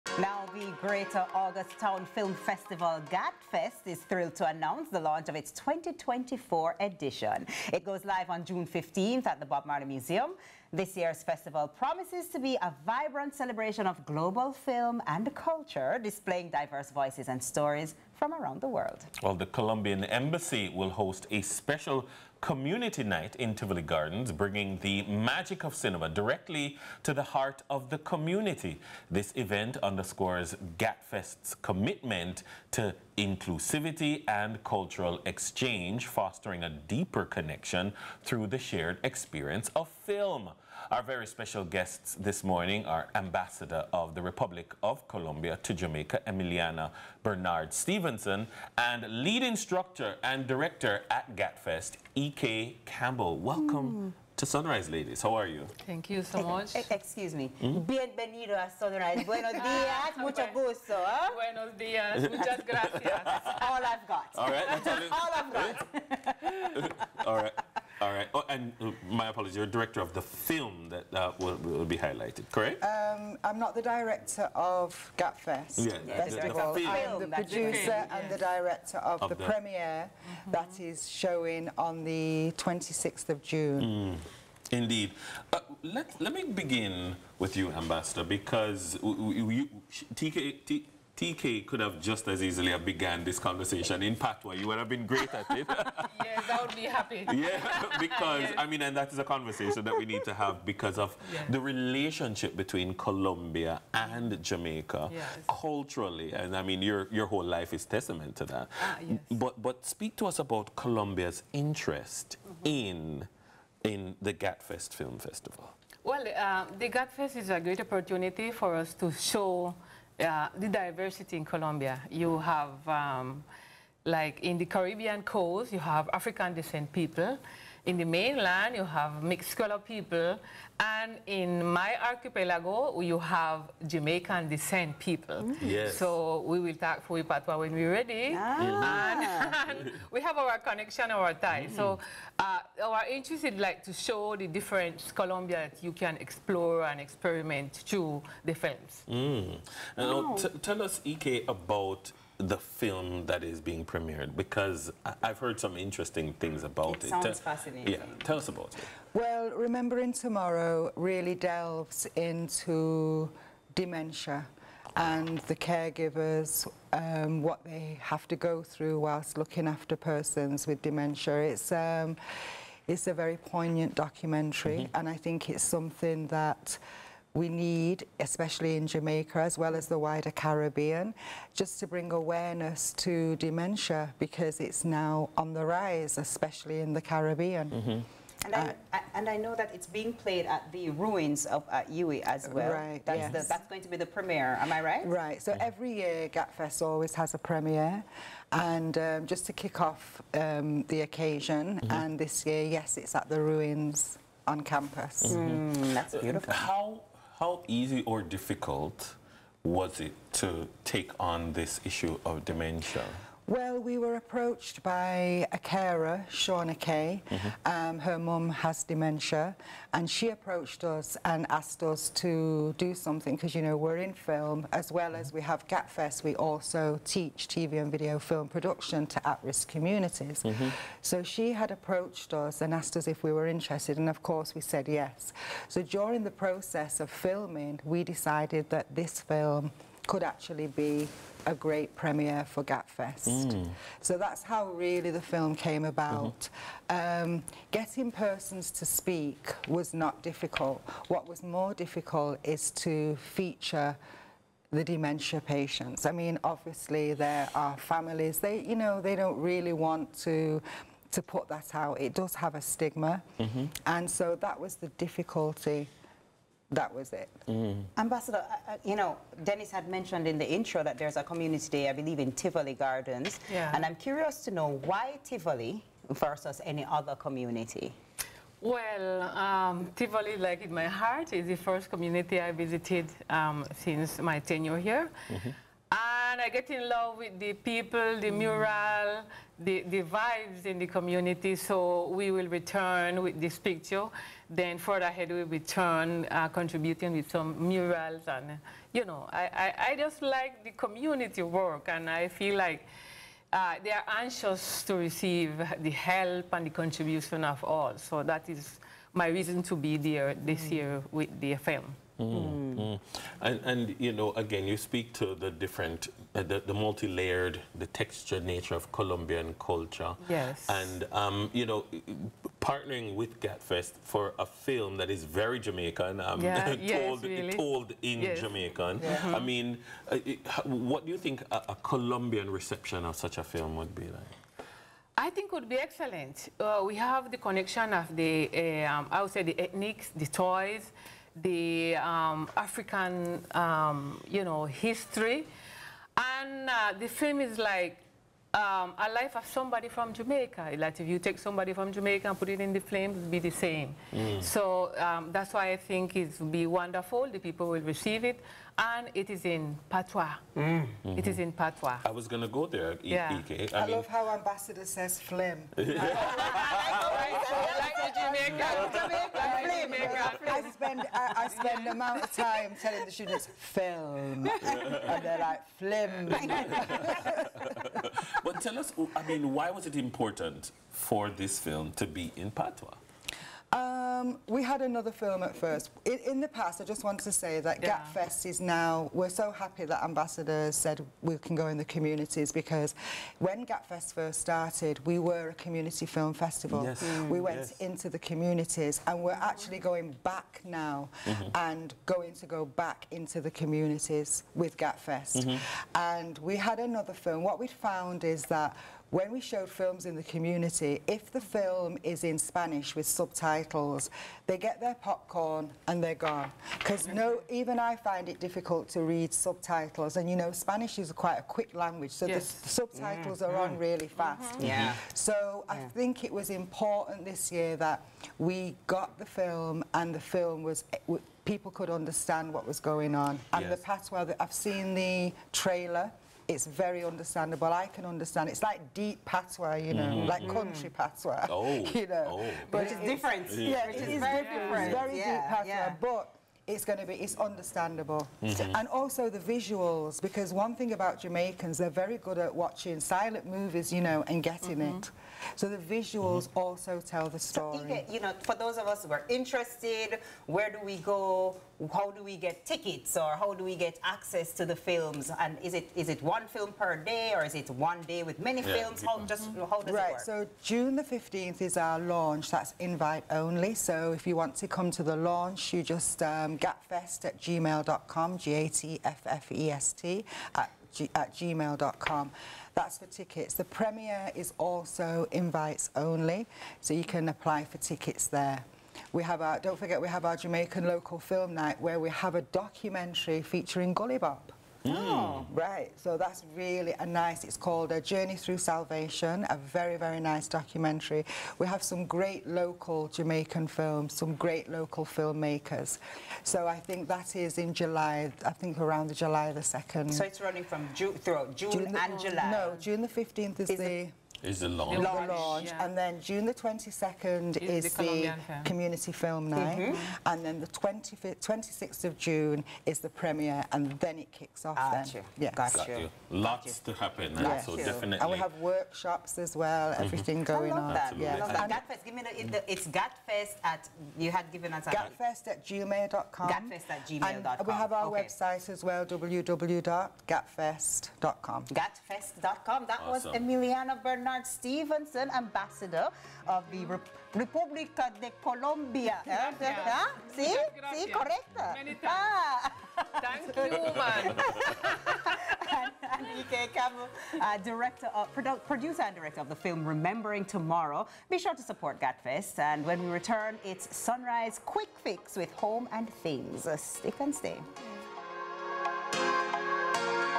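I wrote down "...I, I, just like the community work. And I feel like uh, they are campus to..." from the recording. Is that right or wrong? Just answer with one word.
wrong.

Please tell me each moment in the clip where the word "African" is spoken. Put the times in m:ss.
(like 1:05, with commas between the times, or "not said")
2:06, 5:42.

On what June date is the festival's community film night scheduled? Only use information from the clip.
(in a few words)
June 22.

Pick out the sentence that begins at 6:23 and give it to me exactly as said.
Uh, um, we had another film at first.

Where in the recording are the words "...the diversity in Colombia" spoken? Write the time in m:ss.
2:00.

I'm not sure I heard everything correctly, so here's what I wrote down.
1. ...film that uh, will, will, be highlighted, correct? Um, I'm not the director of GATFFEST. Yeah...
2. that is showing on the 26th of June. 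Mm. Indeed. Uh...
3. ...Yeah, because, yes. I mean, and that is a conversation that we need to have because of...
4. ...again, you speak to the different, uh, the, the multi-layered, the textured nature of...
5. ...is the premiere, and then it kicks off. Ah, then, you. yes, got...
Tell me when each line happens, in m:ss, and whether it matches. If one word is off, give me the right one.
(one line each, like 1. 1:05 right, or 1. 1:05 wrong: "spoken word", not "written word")
1. 1:10 right
2. 1:20 right
3. 1:37 right
4. 5:14 right
5. 8:42 right.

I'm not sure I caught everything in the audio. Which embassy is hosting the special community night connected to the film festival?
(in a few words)
Colombian Embassy.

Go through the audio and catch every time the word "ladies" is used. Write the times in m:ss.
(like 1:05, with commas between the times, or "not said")
0:54.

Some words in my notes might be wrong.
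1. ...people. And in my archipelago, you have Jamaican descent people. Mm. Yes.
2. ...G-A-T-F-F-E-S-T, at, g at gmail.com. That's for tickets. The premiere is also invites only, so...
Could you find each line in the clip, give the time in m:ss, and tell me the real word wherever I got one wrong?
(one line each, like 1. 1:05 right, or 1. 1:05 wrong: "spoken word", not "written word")
1. 2:09 right
2. 7:58 right.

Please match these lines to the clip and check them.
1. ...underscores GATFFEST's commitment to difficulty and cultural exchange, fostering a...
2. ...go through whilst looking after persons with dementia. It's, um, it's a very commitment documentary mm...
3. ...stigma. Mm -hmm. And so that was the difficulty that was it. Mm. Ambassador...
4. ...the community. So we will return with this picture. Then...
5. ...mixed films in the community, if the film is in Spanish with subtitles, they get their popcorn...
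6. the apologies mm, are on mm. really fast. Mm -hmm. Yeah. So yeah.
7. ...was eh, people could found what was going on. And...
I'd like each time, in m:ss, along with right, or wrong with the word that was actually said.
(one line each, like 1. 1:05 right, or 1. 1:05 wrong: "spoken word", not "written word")
1. 0:29 wrong: "inclusivity", not "difficulty"
2. 2:48 wrong: "poignant", not "commitment"
3. 4:22 right
4. 4:50 right
5. 6:49 wrong: "showed", not "mixed"
6. 7:02 wrong: "subtitles", not "apologies"
7. 7:10 wrong: "understand", not "found".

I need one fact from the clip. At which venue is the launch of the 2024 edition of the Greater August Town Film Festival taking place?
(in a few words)
Bob Marley Museum.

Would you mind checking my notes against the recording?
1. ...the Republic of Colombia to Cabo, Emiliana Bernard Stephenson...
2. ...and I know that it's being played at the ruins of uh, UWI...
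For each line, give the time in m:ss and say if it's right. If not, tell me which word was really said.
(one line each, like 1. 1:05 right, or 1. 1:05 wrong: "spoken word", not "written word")
1. 0:44 wrong: "Jamaica", not "Cabo"
2. 3:09 right.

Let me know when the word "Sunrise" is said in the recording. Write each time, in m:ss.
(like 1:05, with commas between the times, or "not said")
0:54, 0:58, 9:23.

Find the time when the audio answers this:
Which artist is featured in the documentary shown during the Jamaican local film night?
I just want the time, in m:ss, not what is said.
8:13.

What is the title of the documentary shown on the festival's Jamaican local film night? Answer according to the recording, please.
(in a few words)
A Journey Through Salvation.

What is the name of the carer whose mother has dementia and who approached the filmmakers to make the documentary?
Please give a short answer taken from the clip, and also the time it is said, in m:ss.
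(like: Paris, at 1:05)
Shauna Kay, at 3:36.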